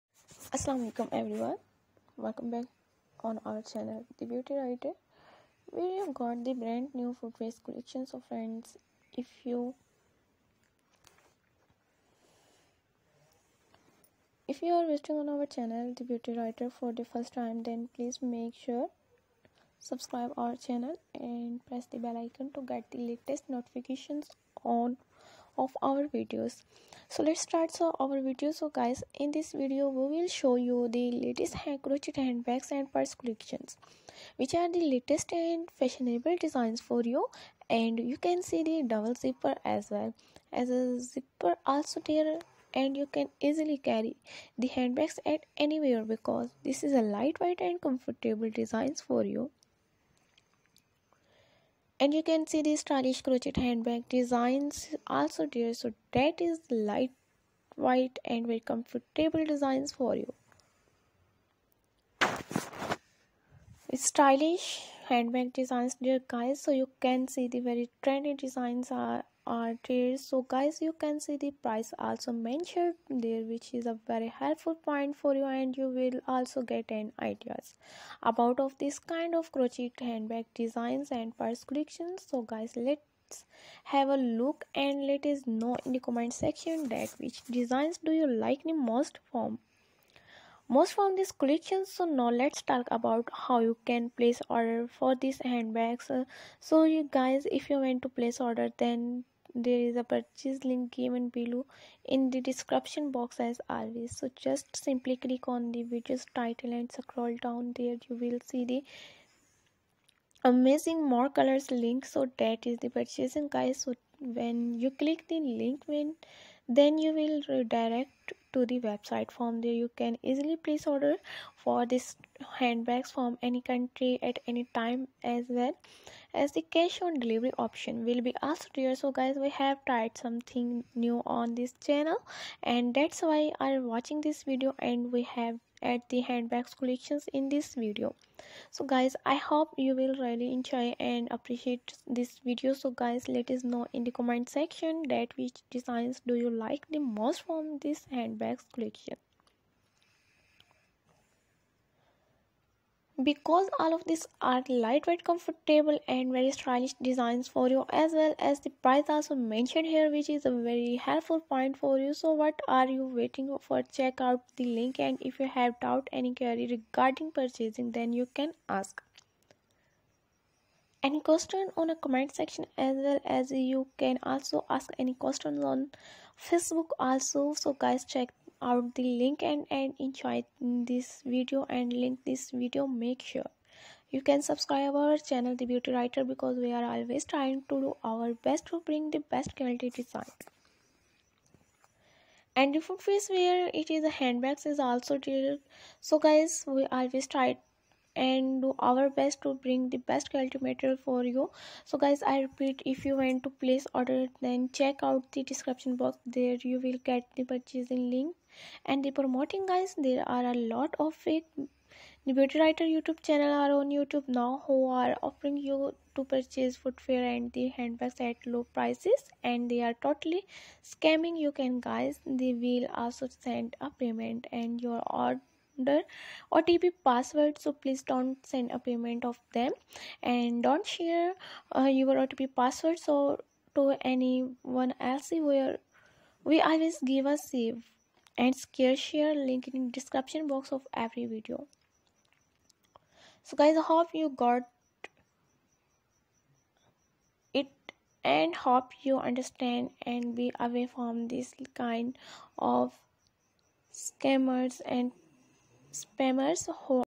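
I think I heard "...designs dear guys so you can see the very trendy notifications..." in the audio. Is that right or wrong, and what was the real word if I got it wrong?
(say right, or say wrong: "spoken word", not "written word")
wrong: "designs", not "notifications".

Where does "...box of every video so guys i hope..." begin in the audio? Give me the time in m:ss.
4:00.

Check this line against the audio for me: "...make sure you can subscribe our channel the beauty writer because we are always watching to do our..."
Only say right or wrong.
wrong.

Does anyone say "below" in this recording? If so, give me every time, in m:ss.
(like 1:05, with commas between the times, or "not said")
1:41.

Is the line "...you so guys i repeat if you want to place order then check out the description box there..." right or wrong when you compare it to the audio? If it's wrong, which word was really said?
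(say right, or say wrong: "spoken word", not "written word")
right.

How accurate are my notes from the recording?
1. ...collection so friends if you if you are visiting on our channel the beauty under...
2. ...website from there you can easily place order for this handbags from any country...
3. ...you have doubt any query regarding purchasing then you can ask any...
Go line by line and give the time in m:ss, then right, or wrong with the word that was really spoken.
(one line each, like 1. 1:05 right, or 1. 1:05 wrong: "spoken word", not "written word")
1. 0:07 wrong: "writer", not "under"
2. 1:58 right
3. 2:45 right.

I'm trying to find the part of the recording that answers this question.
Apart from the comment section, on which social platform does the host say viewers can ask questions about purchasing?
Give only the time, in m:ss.
2:56.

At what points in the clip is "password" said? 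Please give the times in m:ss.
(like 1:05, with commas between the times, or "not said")
3:47, 3:52.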